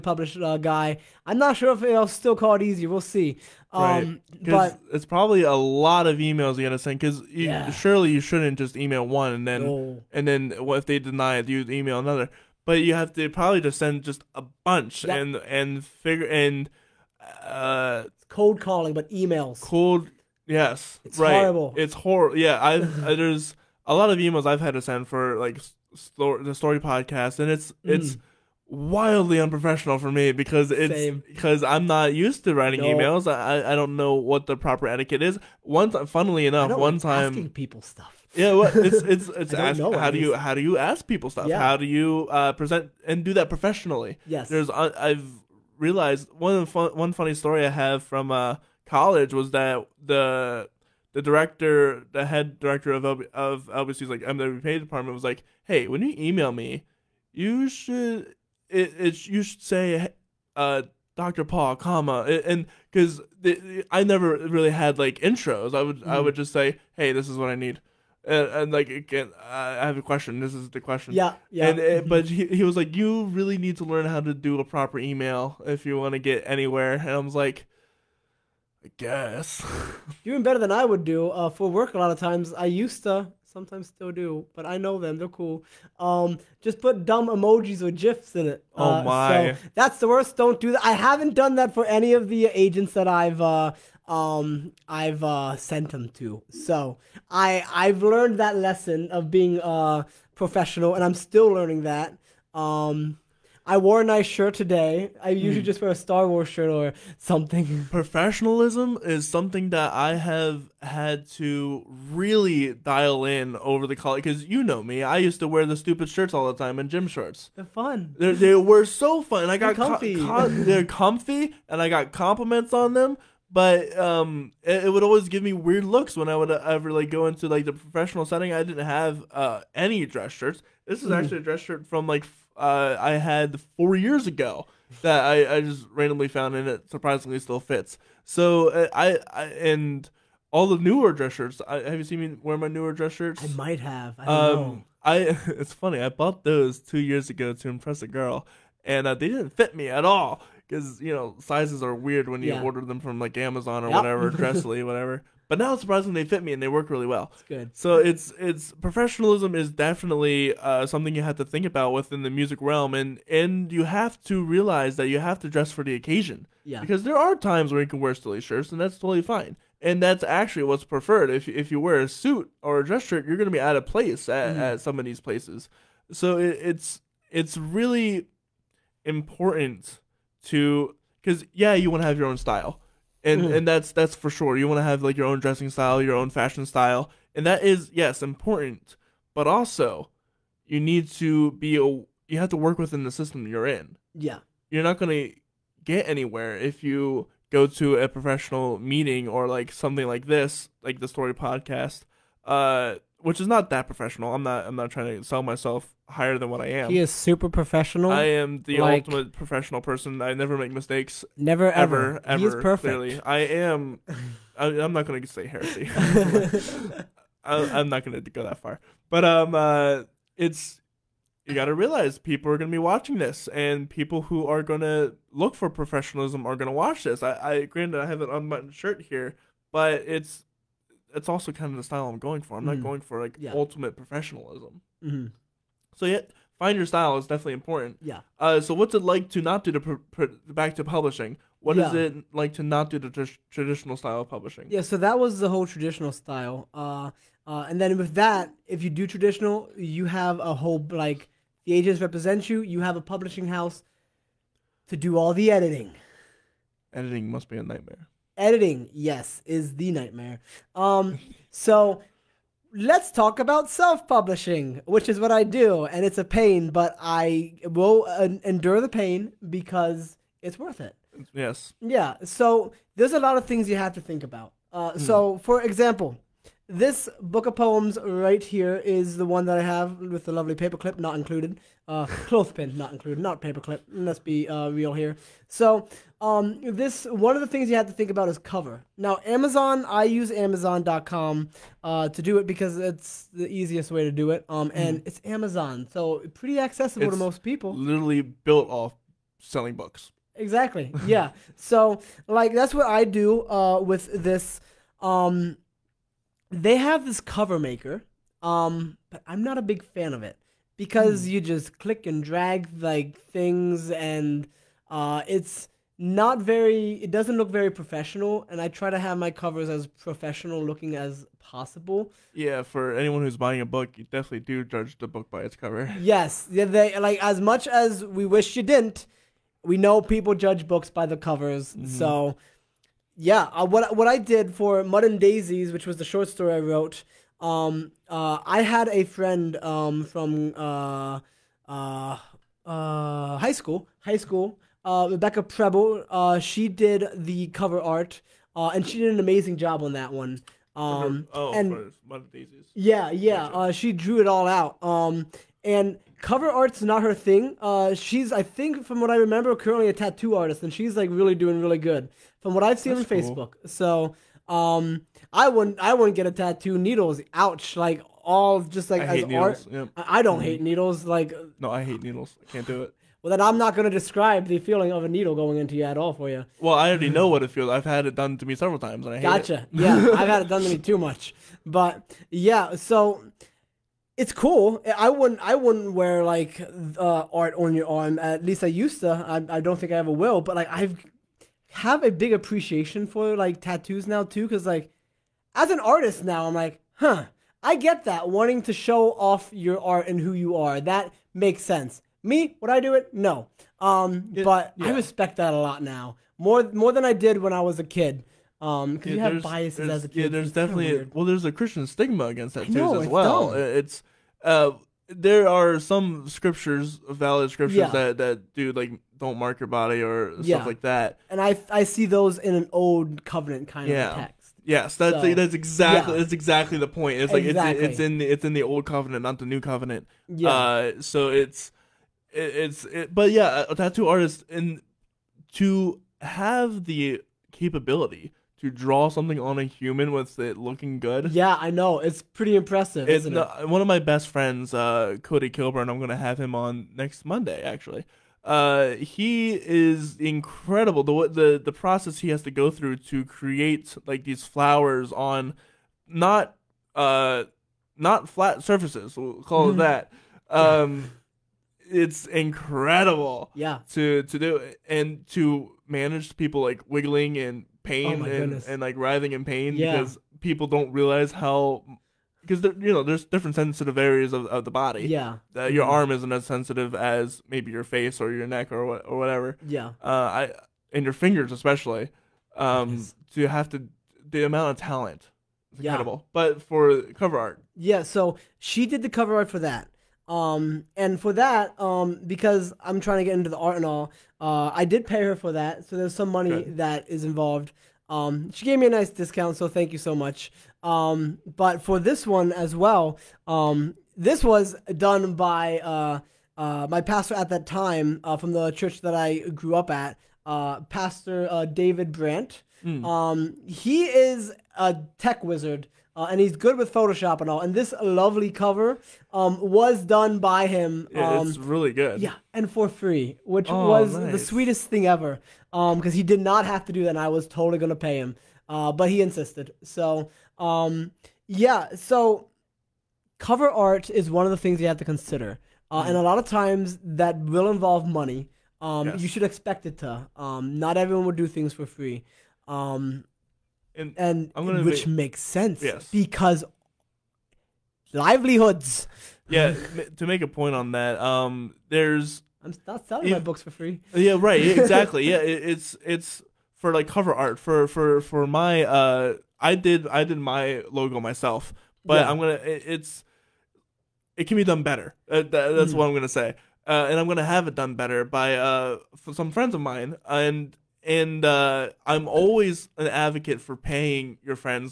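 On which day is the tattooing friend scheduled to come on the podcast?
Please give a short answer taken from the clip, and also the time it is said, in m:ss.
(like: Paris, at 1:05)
next Monday, at 7:26.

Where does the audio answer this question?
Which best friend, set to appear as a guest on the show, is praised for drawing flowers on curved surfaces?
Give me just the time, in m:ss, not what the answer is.
7:25.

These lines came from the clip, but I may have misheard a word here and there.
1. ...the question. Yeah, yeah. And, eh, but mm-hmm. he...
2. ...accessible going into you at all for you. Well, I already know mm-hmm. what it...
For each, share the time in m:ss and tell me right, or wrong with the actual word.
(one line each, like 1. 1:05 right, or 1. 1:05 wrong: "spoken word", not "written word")
1. 1:10 right
2. 6:15 wrong: "needle", not "accessible".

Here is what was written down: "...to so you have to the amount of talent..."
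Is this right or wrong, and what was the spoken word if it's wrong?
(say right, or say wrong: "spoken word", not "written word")
right.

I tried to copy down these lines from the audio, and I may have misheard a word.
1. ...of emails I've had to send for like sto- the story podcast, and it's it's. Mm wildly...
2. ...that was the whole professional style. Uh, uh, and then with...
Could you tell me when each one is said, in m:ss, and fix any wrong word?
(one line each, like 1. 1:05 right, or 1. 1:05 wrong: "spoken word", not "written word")
1. 0:24 right
2. 4:04 wrong: "traditional", not "professional".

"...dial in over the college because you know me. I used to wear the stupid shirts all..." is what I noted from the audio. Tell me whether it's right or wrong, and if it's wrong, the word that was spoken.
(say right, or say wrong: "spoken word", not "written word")
right.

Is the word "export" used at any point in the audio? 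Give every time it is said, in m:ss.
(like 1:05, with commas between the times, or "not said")
not said.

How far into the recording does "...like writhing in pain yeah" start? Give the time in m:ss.
7:48.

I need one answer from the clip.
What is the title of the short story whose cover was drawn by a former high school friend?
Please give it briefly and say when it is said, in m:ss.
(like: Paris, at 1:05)
Mud and Daisies, at 5:34.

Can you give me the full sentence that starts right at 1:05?
I would mm I would just say, hey, this is what I need.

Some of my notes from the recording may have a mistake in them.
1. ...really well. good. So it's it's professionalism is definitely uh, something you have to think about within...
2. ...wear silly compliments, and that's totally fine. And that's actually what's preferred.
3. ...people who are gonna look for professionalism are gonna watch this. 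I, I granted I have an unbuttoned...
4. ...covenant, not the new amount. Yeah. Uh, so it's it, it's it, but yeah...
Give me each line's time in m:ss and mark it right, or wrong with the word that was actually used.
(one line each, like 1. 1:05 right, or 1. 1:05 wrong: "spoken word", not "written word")
1. 2:36 right
2. 2:47 wrong: "shirts", not "compliments"
3. 3:43 right
4. 7:08 wrong: "covenant", not "amount".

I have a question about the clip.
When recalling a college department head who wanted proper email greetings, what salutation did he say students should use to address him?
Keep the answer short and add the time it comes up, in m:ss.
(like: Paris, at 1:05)
Dr. Paul, at 1:01.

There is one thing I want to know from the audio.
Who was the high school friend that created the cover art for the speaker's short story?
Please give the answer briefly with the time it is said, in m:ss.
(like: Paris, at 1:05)
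Rebecca Preble, at 5:45.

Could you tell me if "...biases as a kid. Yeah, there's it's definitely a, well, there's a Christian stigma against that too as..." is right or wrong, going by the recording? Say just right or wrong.
right.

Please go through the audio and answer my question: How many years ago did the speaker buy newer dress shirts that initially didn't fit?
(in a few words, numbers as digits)
2.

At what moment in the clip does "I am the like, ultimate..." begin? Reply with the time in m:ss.
3:28.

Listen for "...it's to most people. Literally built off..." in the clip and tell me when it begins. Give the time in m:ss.
4:57.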